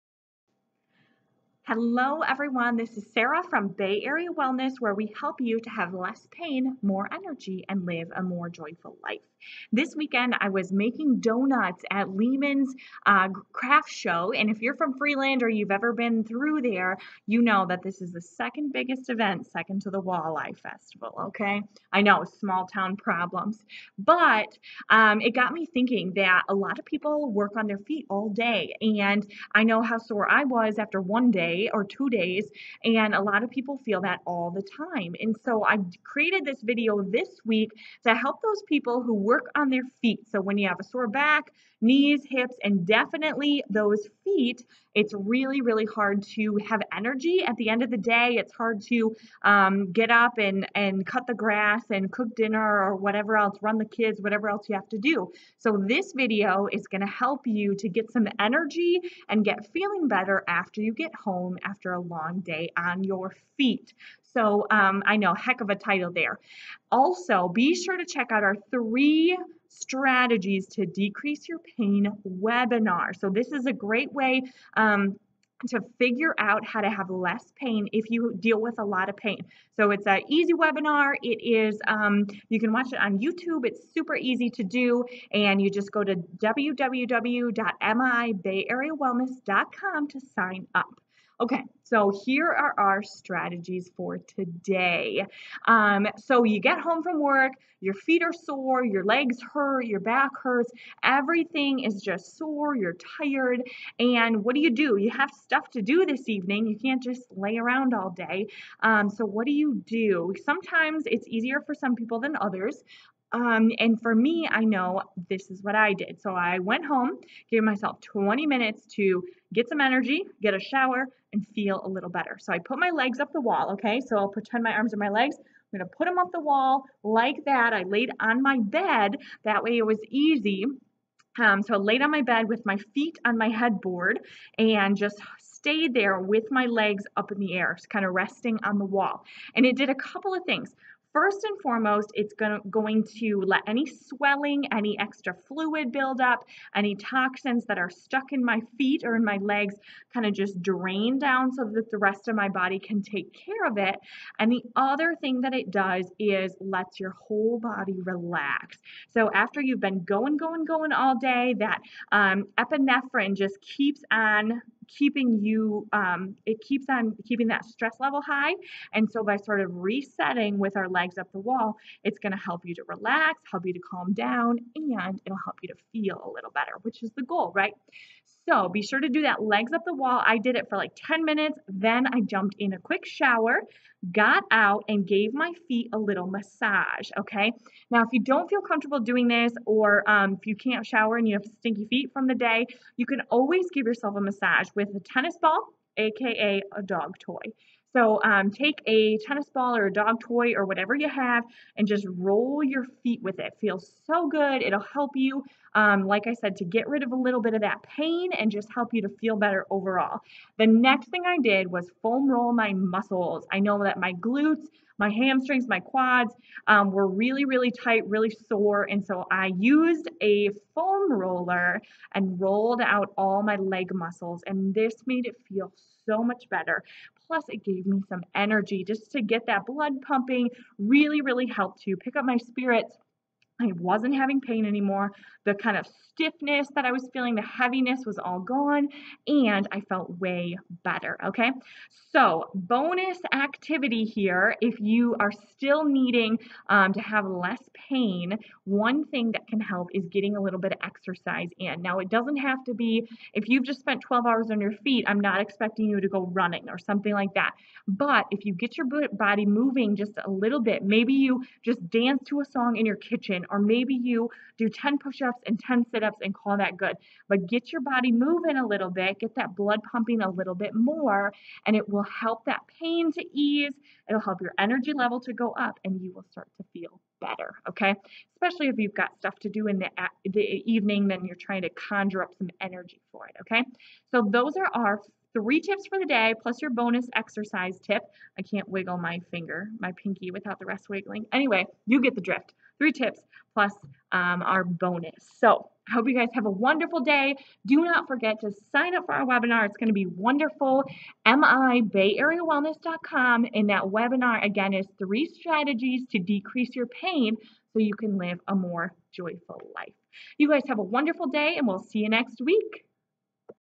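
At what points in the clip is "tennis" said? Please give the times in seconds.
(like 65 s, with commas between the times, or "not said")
194 s, 199 s.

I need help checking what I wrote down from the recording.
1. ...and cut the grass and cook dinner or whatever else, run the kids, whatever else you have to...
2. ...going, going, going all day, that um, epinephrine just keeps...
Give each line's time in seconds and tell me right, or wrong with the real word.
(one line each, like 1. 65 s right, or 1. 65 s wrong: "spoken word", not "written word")
1. 50 s right
2. 160 s right.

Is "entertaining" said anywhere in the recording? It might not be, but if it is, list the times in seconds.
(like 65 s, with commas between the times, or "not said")
not said.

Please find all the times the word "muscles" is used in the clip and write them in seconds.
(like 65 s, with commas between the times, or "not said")
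212 s, 223 s.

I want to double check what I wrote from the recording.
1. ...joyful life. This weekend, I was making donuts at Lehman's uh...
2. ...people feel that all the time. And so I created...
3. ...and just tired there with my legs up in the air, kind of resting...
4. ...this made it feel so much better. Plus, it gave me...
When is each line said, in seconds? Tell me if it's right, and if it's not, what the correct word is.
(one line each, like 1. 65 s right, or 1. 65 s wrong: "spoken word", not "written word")
1. 8 s right
2. 33 s right
3. 134 s wrong: "stayed", not "tired"
4. 224 s right.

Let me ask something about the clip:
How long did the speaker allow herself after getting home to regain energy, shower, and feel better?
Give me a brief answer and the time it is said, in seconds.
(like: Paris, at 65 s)
20 minutes, at 118 s.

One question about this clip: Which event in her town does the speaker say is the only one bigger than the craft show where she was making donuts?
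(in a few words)
Walleye Festival.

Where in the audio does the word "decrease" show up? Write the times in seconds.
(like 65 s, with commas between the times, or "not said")
70 s, 306 s.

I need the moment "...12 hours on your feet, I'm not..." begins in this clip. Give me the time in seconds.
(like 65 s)
254 s.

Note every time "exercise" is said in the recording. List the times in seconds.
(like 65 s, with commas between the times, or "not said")
250 s, 287 s.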